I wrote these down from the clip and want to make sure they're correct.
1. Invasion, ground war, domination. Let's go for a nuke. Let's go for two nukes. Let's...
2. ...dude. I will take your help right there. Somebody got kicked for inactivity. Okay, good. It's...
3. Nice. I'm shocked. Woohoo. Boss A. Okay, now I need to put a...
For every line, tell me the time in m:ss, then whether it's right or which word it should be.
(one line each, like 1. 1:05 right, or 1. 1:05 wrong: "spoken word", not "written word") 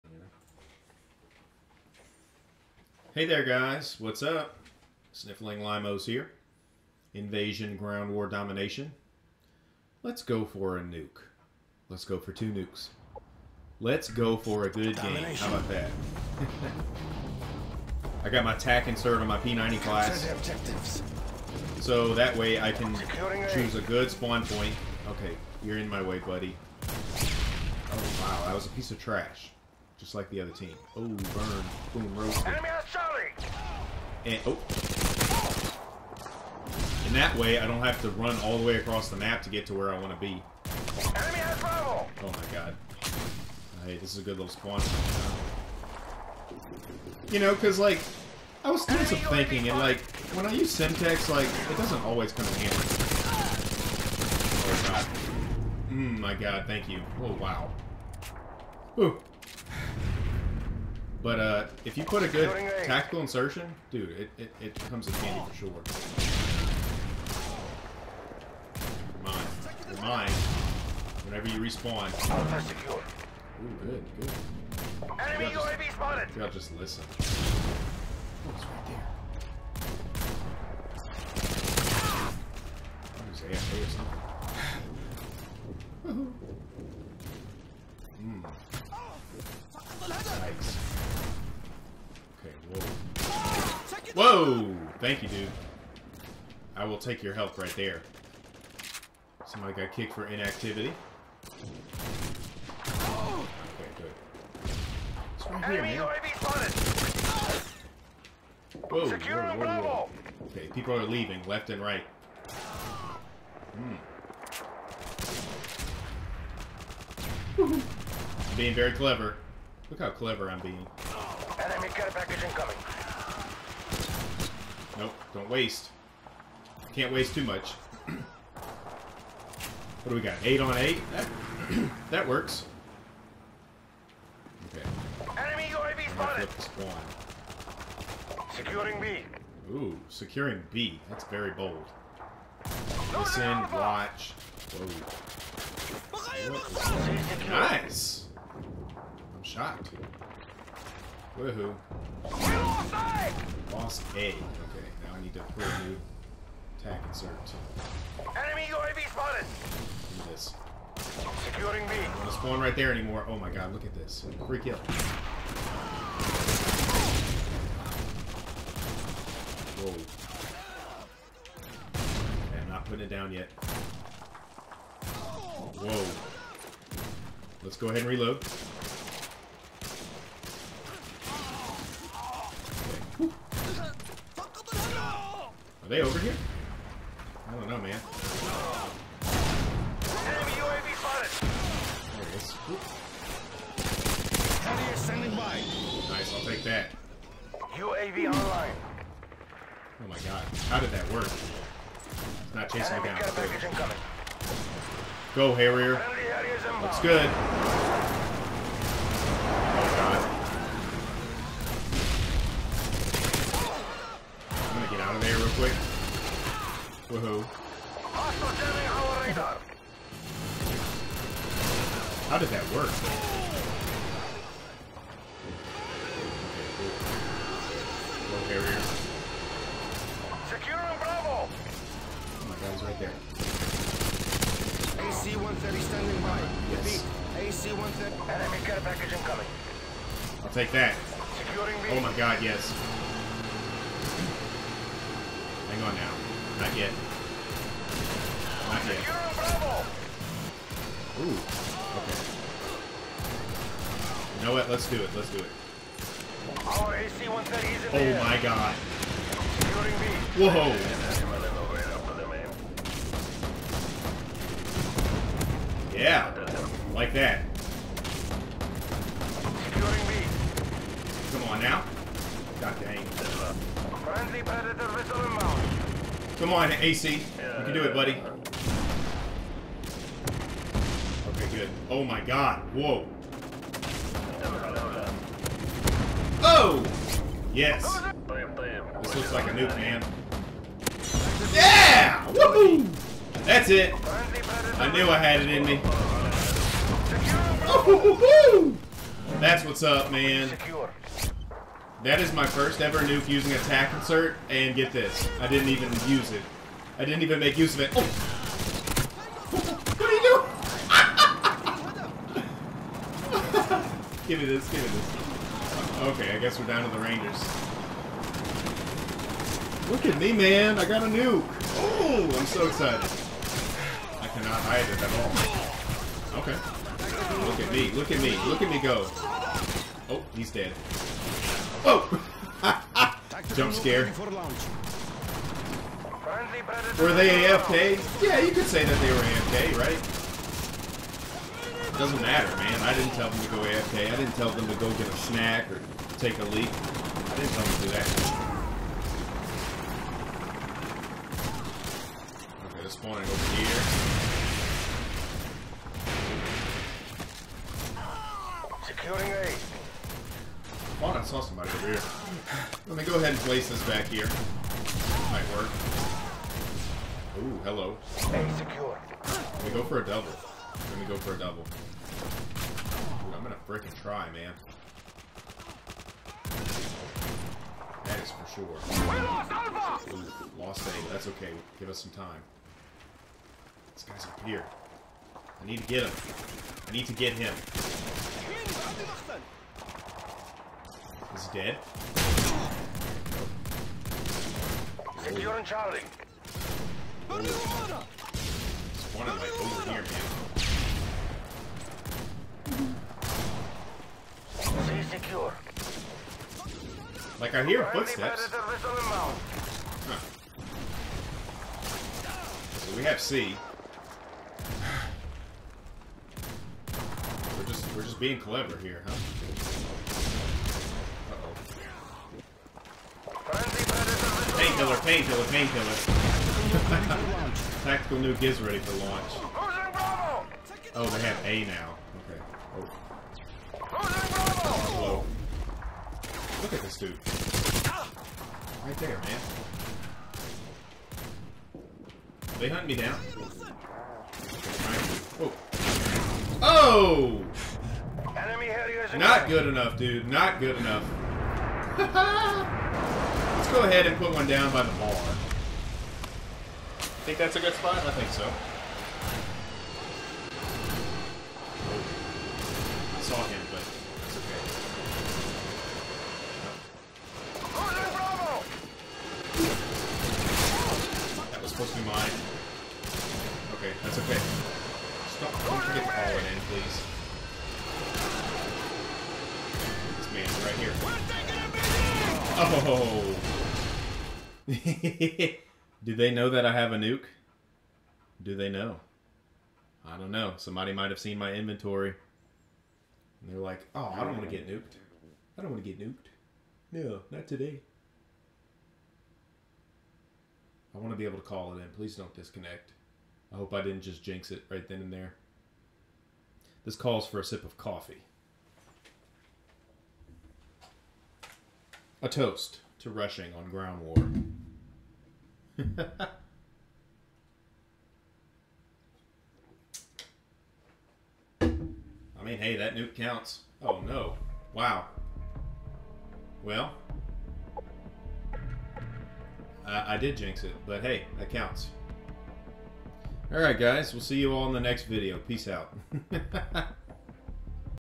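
1. 0:07 right
2. 1:35 right
3. 2:27 right.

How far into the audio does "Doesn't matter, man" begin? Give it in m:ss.
5:41.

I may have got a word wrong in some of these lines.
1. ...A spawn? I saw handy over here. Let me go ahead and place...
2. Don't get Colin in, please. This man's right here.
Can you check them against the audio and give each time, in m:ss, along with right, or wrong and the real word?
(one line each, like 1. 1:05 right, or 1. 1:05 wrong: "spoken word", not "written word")
1. 5:59 wrong: "somebody", not "handy"
2. 7:55 right.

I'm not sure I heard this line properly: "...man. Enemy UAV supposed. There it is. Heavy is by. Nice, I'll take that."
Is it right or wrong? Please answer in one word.
wrong.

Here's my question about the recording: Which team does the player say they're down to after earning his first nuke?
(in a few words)
Rangers.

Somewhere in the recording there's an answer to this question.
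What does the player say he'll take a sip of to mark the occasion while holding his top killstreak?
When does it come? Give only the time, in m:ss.
8:27.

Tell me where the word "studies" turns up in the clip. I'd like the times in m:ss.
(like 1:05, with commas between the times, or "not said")
not said.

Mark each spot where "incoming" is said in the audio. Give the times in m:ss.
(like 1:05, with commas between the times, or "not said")
2:02, 3:59.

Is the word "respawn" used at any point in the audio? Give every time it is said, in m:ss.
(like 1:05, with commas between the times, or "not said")
1:11.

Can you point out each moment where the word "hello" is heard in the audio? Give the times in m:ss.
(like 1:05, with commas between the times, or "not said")
6:07, 7:14.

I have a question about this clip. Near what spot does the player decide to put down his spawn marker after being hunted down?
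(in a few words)
The bar.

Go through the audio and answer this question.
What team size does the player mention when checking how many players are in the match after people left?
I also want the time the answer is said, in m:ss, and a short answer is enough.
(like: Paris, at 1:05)
Eight on eight, at 2:10.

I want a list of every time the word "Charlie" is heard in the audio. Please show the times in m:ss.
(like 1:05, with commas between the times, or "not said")
0:32, 6:35.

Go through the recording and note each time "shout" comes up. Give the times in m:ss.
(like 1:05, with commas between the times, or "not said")
not said.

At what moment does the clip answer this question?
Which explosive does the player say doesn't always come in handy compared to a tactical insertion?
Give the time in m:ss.
0:50.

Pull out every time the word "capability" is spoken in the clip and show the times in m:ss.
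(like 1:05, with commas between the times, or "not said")
not said.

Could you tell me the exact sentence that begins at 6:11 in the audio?
Dude, I'm gonna freaking try, man.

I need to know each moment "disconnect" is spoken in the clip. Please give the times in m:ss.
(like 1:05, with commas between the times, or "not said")
8:22.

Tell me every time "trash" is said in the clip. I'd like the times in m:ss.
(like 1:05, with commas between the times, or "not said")
0:29.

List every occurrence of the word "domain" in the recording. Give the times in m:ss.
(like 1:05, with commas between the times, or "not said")
not said.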